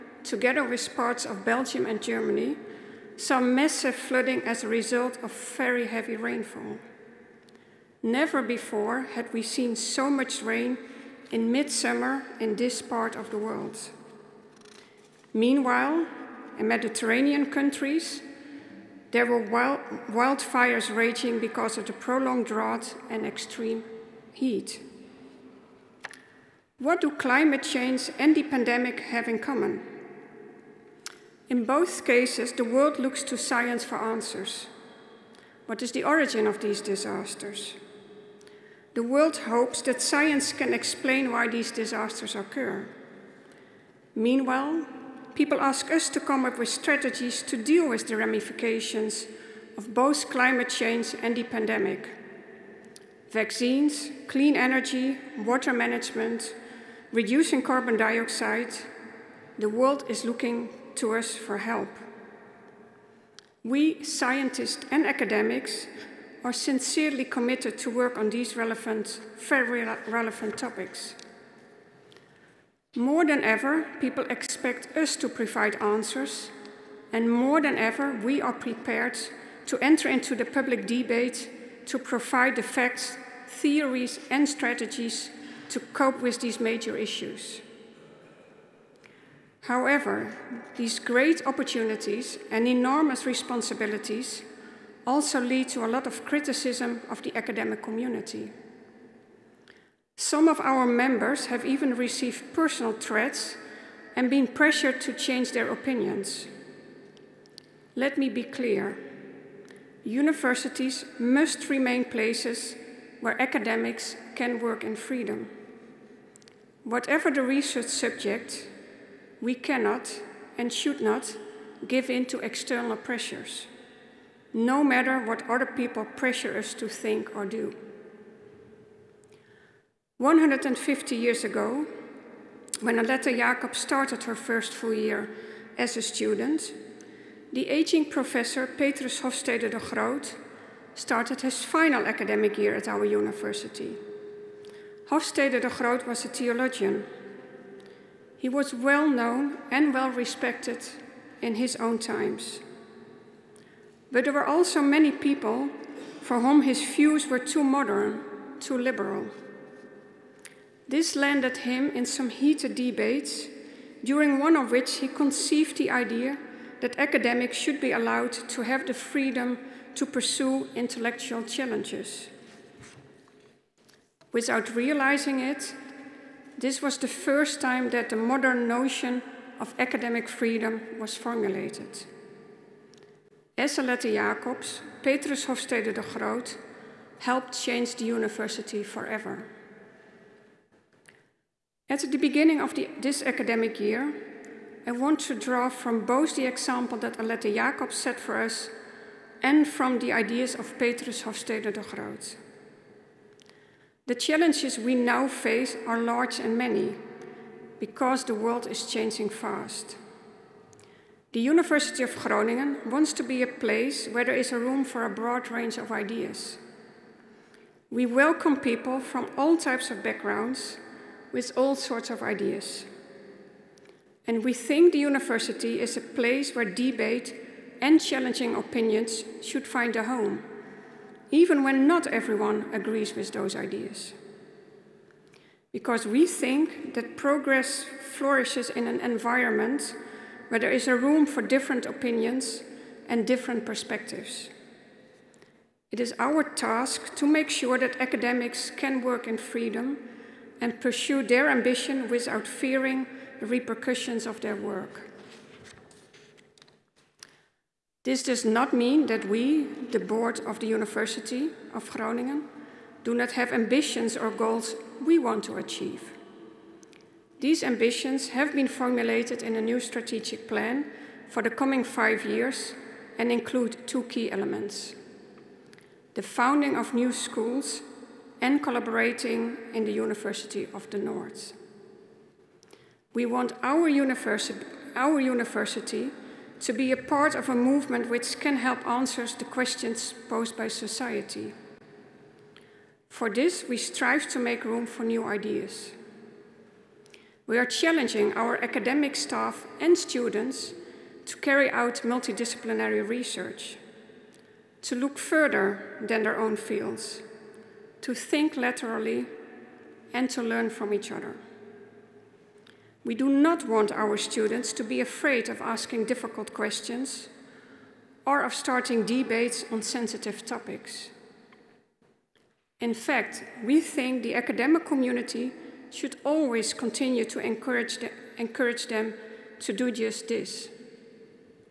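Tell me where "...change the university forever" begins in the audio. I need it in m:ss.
3:07.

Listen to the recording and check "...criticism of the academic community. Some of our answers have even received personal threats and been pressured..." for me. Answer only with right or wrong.
wrong.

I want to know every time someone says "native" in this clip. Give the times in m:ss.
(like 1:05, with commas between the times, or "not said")
not said.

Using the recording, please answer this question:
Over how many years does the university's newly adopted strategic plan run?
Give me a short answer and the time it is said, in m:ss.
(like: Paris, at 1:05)
5, at 4:31.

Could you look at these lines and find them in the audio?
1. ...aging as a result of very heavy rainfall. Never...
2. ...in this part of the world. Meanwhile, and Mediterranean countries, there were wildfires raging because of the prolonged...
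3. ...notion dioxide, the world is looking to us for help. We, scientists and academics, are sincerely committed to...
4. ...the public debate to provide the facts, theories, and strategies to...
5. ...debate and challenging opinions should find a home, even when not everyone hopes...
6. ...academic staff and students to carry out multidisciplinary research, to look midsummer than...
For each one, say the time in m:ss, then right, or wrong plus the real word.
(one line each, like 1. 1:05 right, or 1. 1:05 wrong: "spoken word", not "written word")
1. 0:03 wrong: "flooding", not "aging"
2. 0:12 right
3. 0:57 wrong: "carbon", not "notion"
4. 1:20 right
5. 3:46 wrong: "agrees", not "hopes"
6. 4:58 wrong: "further", not "midsummer".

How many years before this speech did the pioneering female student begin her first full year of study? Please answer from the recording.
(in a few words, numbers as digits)
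150.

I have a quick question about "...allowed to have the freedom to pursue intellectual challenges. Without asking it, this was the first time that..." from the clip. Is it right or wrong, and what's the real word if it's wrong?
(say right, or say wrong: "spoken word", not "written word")
wrong: "realizing", not "asking".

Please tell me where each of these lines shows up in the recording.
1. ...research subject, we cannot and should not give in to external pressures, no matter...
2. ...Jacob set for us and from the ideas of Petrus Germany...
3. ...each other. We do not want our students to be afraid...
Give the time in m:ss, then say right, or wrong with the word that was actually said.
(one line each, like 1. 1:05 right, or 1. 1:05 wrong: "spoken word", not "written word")
1. 1:57 right
2. 3:17 wrong: "Hofstede", not "Germany"
3. 5:10 right.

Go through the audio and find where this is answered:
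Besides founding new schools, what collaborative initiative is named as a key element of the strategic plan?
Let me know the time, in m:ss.
4:39.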